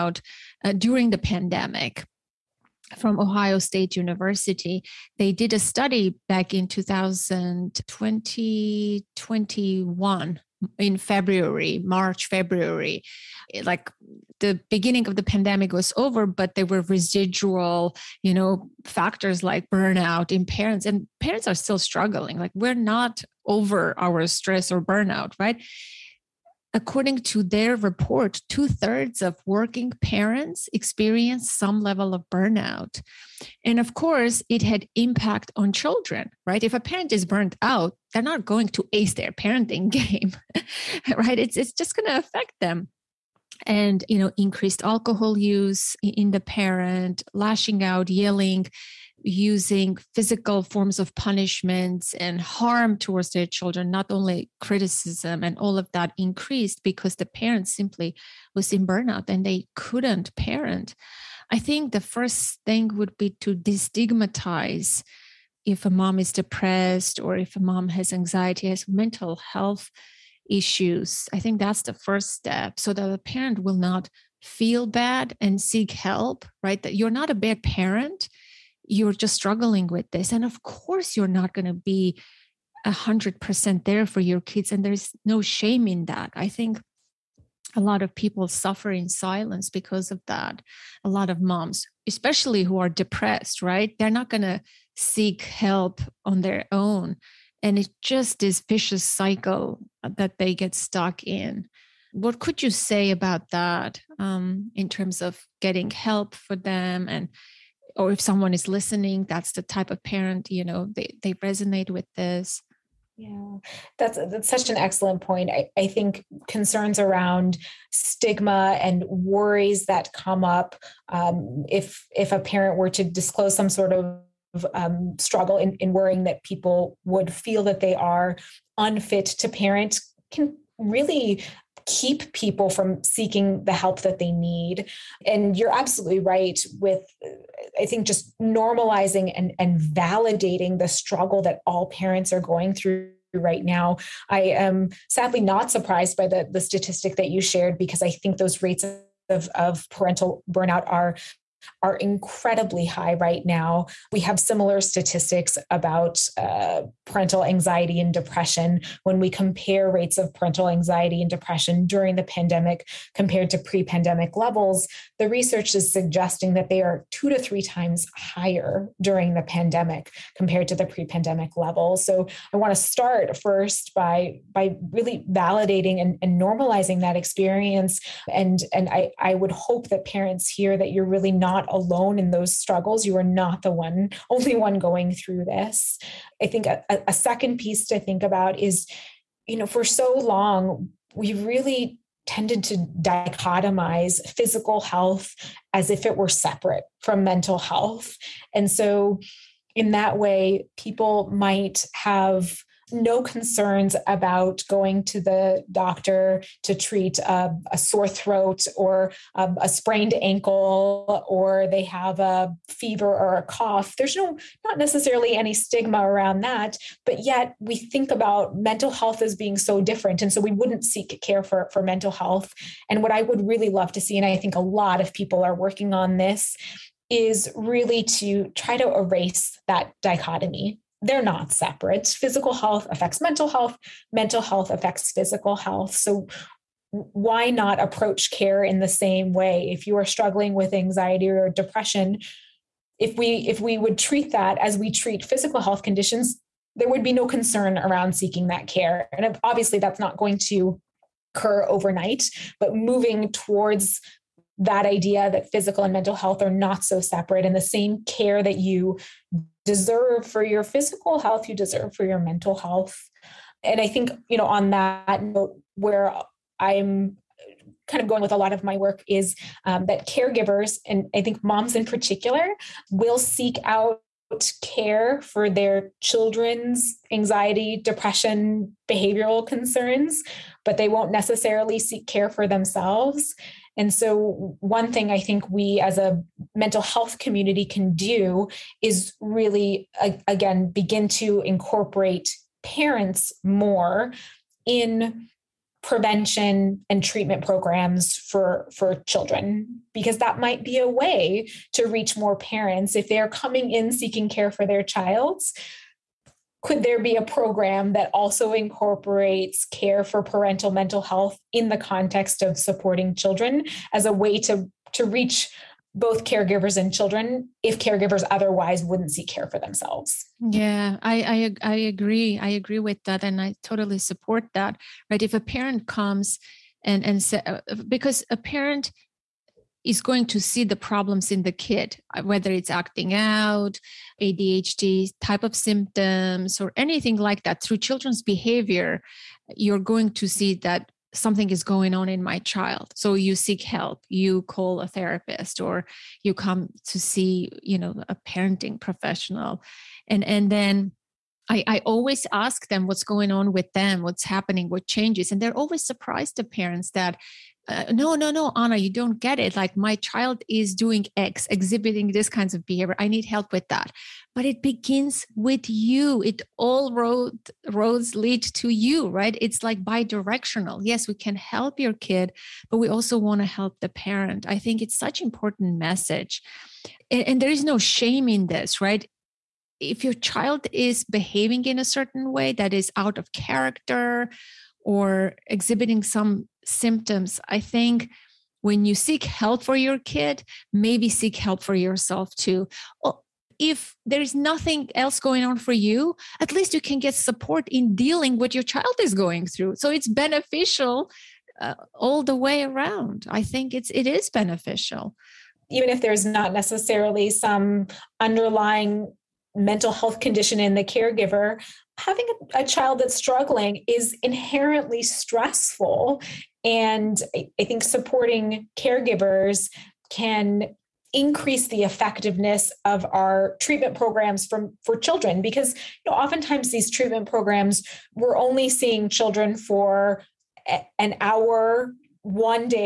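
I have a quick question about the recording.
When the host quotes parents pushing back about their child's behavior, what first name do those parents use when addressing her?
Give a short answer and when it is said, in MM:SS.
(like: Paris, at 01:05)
Anna, at 05:58.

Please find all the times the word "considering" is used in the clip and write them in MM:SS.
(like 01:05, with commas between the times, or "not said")
not said.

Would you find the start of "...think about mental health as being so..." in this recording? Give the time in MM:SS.
03:37.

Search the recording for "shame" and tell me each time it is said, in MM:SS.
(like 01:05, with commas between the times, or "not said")
01:25, 06:17.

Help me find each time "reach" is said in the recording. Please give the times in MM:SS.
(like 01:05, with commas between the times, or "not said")
05:01, 05:15.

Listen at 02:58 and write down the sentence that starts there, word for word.
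And, and I, I would hope that parents hear that you're really not not alone in those struggles.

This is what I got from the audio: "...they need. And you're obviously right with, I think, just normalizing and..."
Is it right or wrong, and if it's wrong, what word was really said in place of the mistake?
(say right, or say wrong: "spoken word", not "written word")
wrong: "absolutely", not "obviously".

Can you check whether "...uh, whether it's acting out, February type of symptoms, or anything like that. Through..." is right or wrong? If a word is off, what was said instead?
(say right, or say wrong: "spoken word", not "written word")
wrong: "ADHD", not "February".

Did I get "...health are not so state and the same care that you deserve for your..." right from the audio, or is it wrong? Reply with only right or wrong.
wrong.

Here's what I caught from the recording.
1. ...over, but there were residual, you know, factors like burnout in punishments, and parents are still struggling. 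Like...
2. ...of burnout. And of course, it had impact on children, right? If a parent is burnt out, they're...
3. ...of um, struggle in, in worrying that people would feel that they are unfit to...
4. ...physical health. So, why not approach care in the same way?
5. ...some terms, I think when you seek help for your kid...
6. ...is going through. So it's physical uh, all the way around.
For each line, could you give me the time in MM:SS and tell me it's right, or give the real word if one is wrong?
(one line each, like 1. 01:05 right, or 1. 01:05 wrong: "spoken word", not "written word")
1. 00:15 wrong: "parents", not "punishments"
2. 00:32 right
3. 02:03 right
4. 03:55 right
5. 06:26 wrong: "symptoms", not "terms"
6. 06:38 wrong: "beneficial", not "physical".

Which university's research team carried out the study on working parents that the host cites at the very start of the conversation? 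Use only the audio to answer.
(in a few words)
Ohio State University.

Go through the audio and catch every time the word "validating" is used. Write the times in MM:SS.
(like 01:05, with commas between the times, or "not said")
02:19, 02:55.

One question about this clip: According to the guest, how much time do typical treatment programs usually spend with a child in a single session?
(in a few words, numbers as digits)
an hour.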